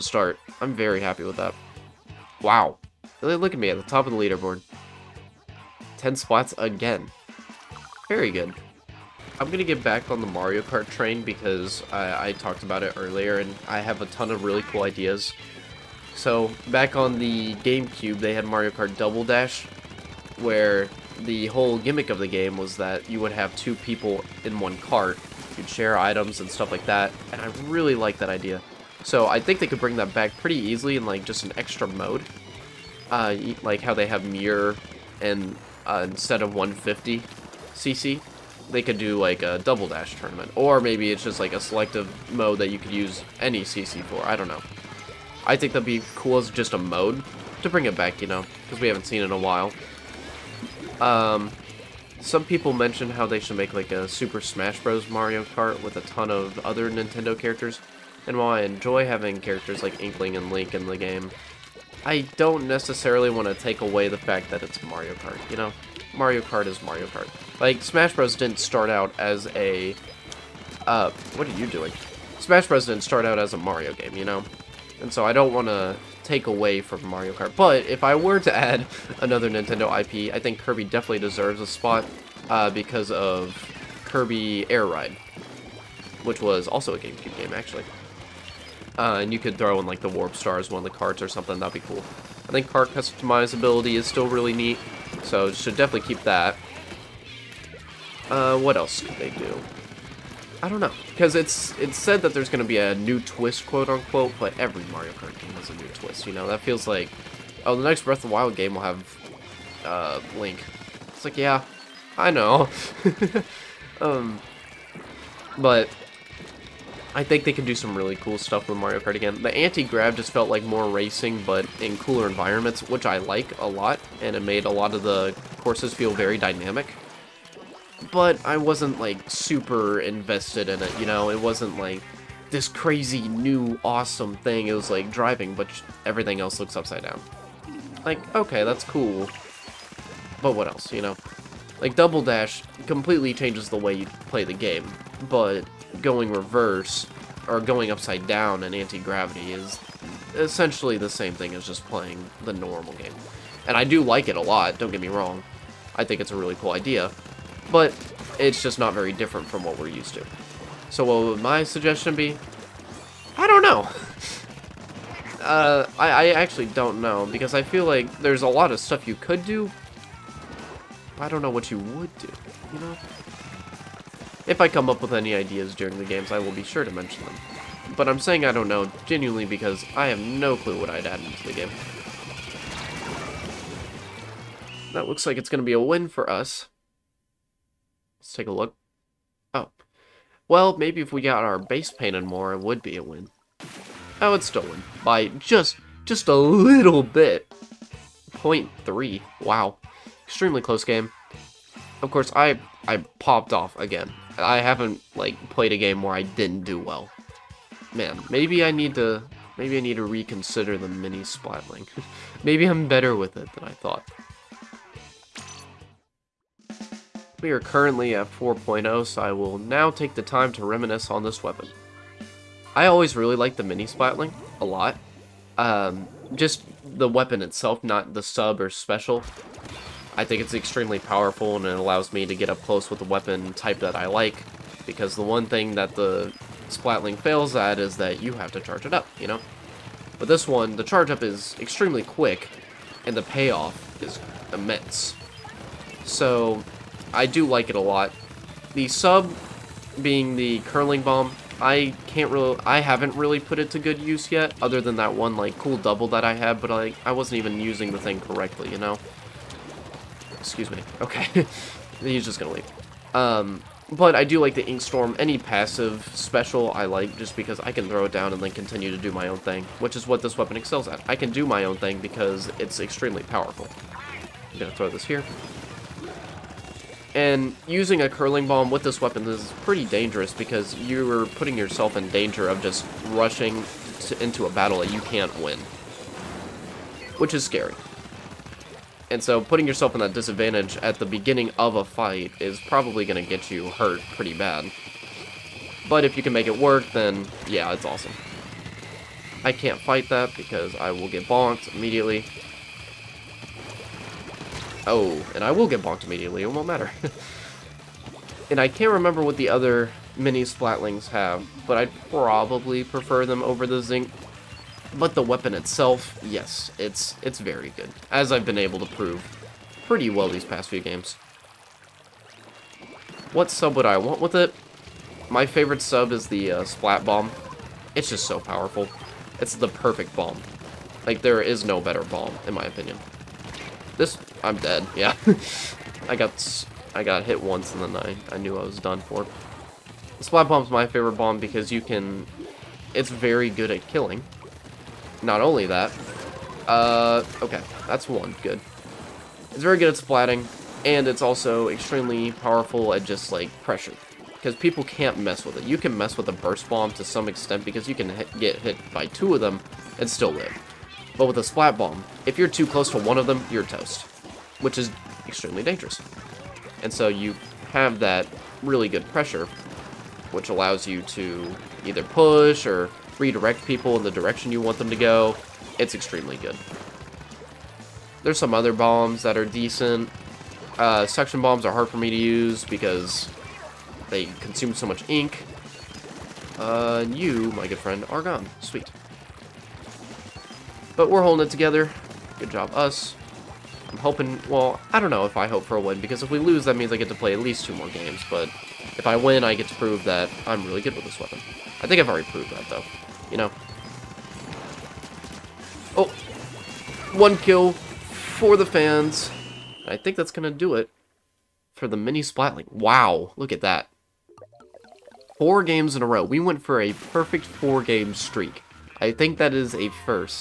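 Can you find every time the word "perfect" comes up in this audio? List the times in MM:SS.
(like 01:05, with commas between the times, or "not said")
05:29, 06:56.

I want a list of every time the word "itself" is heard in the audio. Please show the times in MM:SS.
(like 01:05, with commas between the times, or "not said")
03:47, 05:15.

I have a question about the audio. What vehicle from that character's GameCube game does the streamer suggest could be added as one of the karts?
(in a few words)
Warp Stars.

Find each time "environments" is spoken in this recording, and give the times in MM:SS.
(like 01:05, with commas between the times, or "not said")
02:02.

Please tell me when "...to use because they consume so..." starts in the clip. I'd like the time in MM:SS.
06:22.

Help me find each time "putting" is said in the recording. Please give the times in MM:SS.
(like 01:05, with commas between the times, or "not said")
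04:41, 04:49.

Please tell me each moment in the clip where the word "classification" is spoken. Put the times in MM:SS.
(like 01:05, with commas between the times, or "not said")
not said.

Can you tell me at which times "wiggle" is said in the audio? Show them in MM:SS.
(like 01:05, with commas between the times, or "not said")
not said.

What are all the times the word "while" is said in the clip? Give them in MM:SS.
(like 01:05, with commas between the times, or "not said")
00:49, 00:58.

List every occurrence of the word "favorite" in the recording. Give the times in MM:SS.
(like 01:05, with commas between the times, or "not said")
05:25, 05:40.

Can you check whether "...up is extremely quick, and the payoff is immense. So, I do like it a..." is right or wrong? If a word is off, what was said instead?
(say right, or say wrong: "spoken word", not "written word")
right.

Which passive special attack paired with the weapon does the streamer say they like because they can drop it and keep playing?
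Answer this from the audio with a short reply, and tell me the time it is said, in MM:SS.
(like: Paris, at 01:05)
Ink Storm, at 04:24.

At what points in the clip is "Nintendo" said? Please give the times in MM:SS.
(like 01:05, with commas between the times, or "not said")
00:56, 01:19.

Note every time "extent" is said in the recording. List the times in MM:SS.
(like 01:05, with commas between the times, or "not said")
05:57.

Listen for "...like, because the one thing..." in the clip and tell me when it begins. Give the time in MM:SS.
03:54.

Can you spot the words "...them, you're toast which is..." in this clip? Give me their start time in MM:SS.
06:03.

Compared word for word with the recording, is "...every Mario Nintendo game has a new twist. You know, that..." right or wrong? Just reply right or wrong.
wrong.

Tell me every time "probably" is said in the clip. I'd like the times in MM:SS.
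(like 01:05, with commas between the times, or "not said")
04:52, 05:12.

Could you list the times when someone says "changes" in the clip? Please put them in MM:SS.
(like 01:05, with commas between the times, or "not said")
02:23.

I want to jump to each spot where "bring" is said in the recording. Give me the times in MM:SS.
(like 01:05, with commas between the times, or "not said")
00:29, 00:47.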